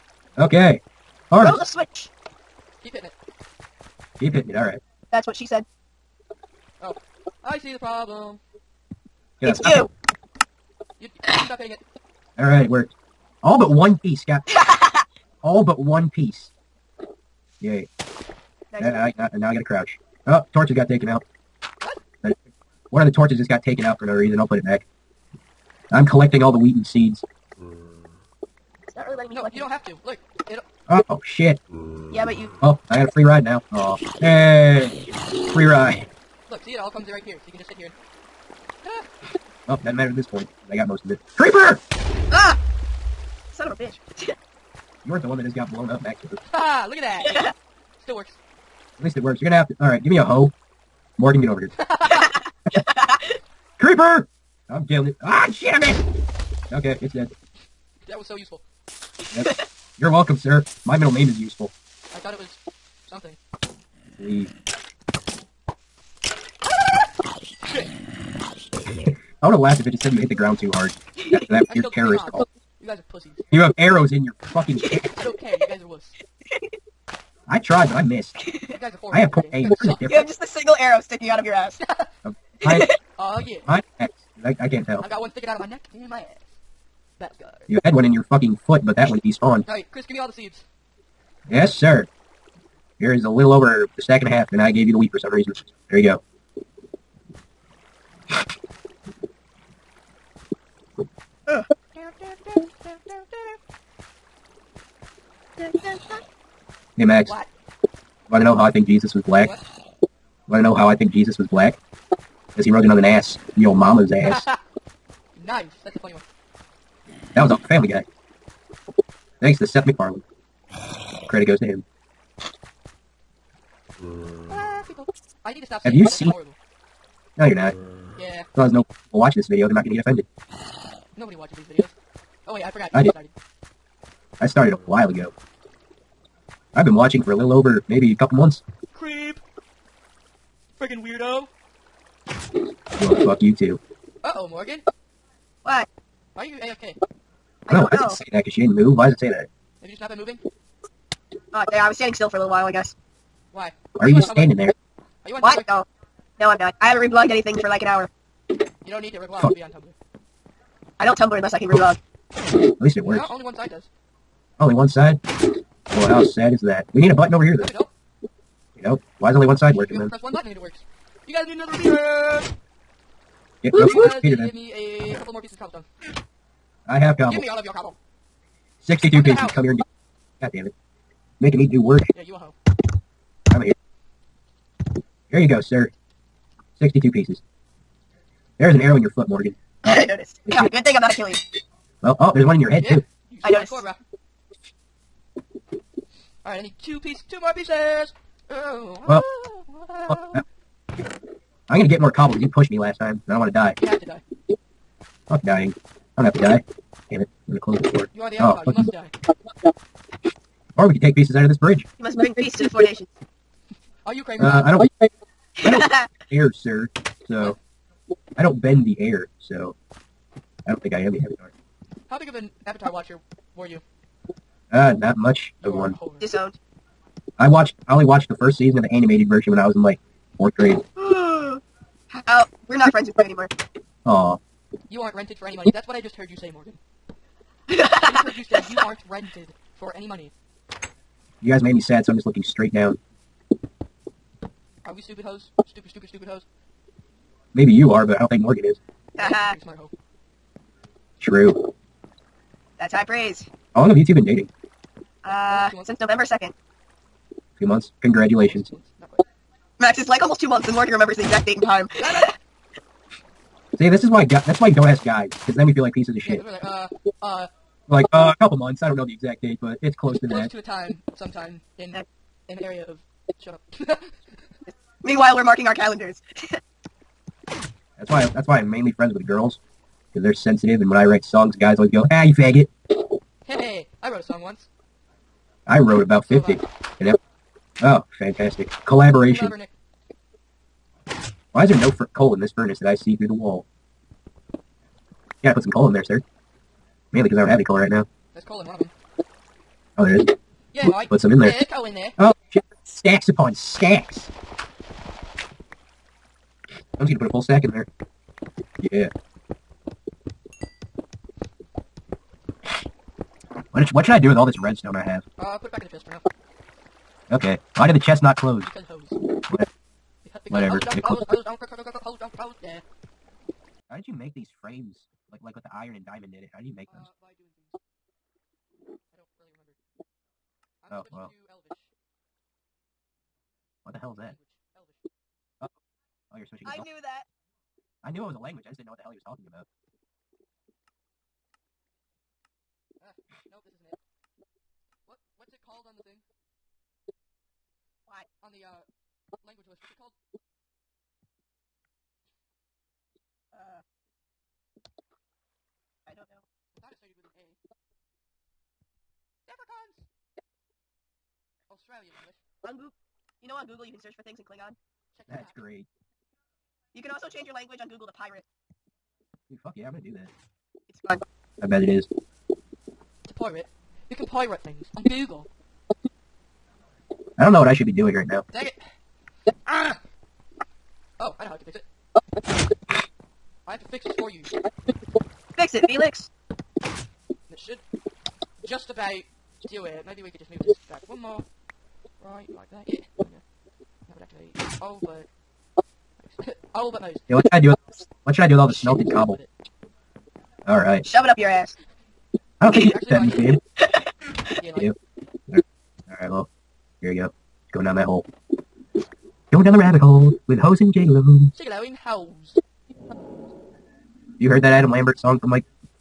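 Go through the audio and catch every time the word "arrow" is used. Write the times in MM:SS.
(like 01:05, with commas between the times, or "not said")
01:13, 01:20, 03:08.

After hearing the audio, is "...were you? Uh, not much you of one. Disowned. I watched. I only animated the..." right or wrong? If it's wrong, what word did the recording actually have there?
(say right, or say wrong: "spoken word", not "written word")
wrong: "watched", not "animated".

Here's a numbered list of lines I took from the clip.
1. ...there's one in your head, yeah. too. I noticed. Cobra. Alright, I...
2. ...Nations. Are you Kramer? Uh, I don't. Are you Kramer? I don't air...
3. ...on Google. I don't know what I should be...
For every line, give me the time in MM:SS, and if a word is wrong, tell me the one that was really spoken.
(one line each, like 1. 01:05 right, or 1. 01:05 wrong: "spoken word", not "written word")
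1. 03:12 right
2. 03:32 right
3. 06:14 right.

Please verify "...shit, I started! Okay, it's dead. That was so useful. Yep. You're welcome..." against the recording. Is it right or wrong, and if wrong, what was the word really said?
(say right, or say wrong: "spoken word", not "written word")
wrong: "missed", not "started".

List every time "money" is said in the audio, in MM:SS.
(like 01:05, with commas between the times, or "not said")
03:55, 04:00.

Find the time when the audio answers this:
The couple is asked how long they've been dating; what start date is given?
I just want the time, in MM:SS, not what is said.
04:16.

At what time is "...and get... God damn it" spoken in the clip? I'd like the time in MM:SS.
02:59.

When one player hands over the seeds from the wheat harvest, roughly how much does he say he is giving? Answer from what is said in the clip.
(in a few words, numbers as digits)
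a little over a stack and a half.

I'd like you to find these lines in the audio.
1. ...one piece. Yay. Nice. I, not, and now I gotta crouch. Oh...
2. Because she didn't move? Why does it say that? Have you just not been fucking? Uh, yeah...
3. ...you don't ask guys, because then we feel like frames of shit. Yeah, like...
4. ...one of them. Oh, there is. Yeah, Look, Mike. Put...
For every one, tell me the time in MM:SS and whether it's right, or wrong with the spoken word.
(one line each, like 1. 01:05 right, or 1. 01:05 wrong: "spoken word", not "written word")
1. 00:15 right
2. 02:28 wrong: "moving", not "fucking"
3. 04:24 wrong: "pieces", not "frames"
4. 04:58 right.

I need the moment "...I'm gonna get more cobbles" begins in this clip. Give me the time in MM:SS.
03:21.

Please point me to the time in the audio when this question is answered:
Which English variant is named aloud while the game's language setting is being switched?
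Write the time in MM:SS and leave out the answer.
06:01.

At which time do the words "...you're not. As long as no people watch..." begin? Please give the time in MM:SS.
02:07.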